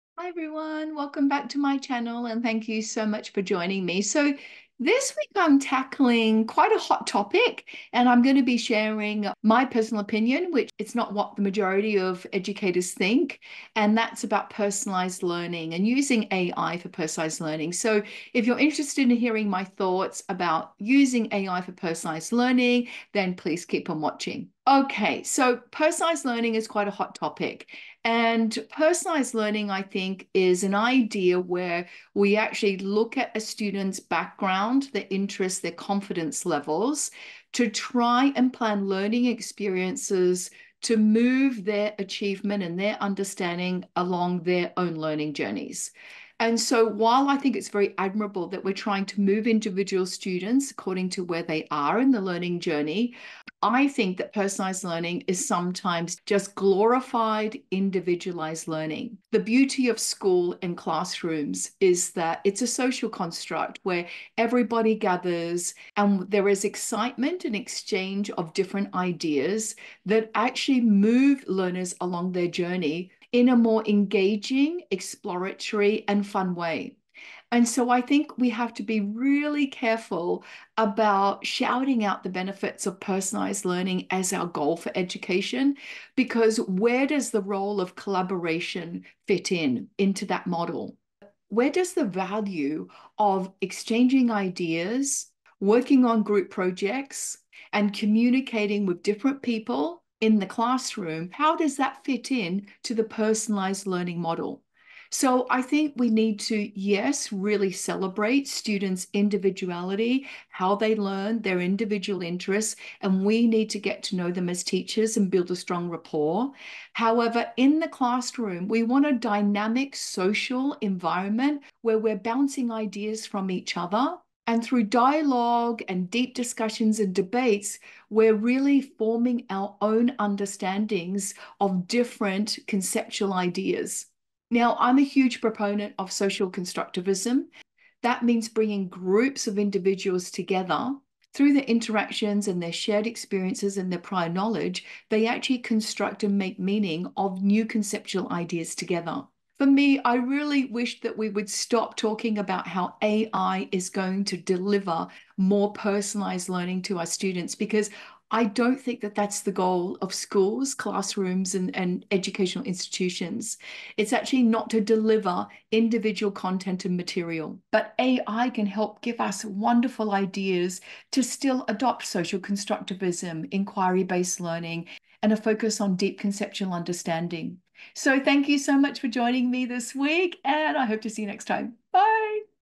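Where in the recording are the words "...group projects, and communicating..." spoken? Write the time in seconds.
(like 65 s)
96 s.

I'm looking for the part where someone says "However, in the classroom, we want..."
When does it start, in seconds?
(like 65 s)
116 s.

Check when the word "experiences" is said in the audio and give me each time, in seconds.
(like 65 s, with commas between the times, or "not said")
39 s, 143 s.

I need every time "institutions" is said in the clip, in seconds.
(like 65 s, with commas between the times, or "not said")
162 s.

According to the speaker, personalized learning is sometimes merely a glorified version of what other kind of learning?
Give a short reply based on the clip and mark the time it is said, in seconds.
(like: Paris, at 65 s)
individualized learning, at 57 s.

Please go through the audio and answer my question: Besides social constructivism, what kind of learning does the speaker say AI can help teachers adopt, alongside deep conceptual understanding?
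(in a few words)
inquiry based learning.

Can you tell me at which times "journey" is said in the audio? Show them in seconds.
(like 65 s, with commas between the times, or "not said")
45 s, 52 s, 72 s.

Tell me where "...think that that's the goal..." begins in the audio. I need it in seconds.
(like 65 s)
158 s.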